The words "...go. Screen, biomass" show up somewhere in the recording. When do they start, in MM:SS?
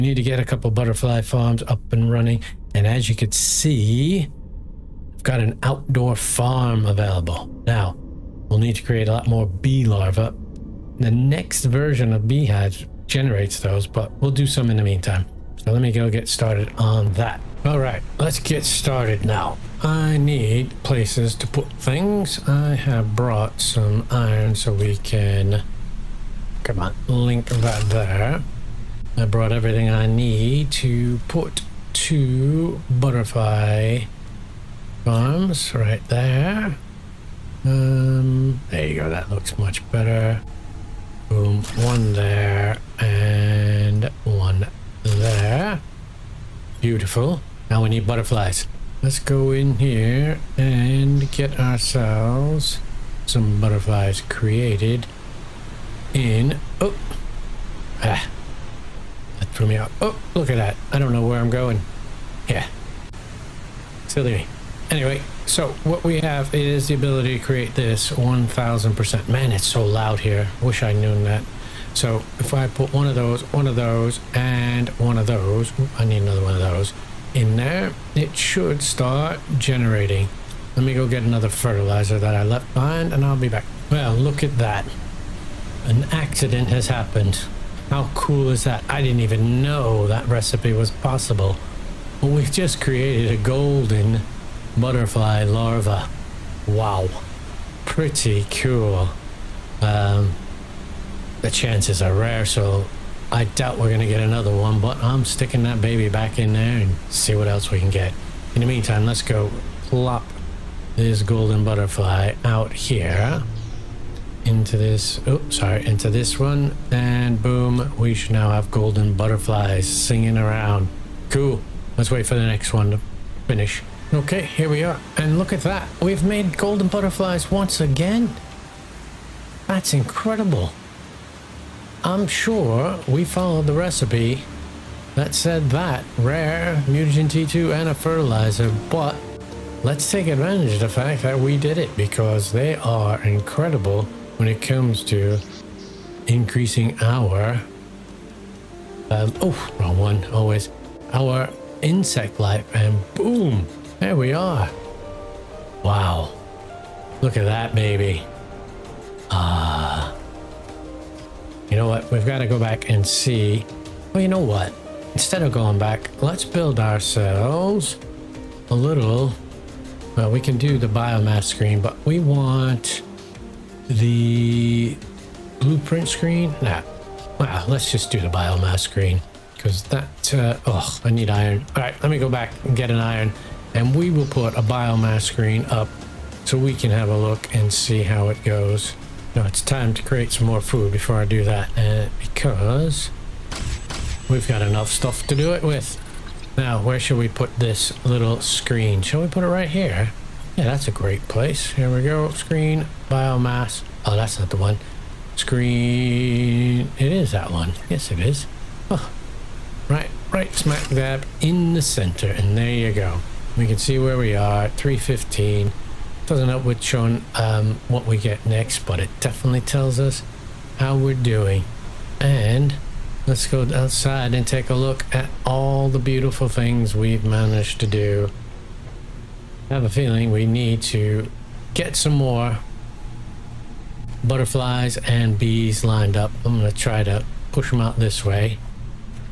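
03:22.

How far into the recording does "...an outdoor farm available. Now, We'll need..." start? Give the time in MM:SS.
00:05.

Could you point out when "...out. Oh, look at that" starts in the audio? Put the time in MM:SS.
00:59.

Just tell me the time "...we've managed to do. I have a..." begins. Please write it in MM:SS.
03:46.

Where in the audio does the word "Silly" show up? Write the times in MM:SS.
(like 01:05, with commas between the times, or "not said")
01:04.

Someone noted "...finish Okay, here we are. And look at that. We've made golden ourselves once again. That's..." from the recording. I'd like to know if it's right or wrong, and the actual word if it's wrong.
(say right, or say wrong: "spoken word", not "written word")
wrong: "butterflies", not "ourselves".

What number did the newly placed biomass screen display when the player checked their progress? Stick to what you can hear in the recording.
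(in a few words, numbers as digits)
315.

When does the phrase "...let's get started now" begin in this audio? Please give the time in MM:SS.
00:18.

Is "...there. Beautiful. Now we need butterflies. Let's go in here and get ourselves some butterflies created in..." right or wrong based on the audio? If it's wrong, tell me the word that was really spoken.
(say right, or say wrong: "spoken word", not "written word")
right.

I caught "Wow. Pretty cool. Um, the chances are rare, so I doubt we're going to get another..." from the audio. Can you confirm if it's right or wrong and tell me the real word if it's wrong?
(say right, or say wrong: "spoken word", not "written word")
right.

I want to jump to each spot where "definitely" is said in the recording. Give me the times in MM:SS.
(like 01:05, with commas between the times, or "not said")
03:39.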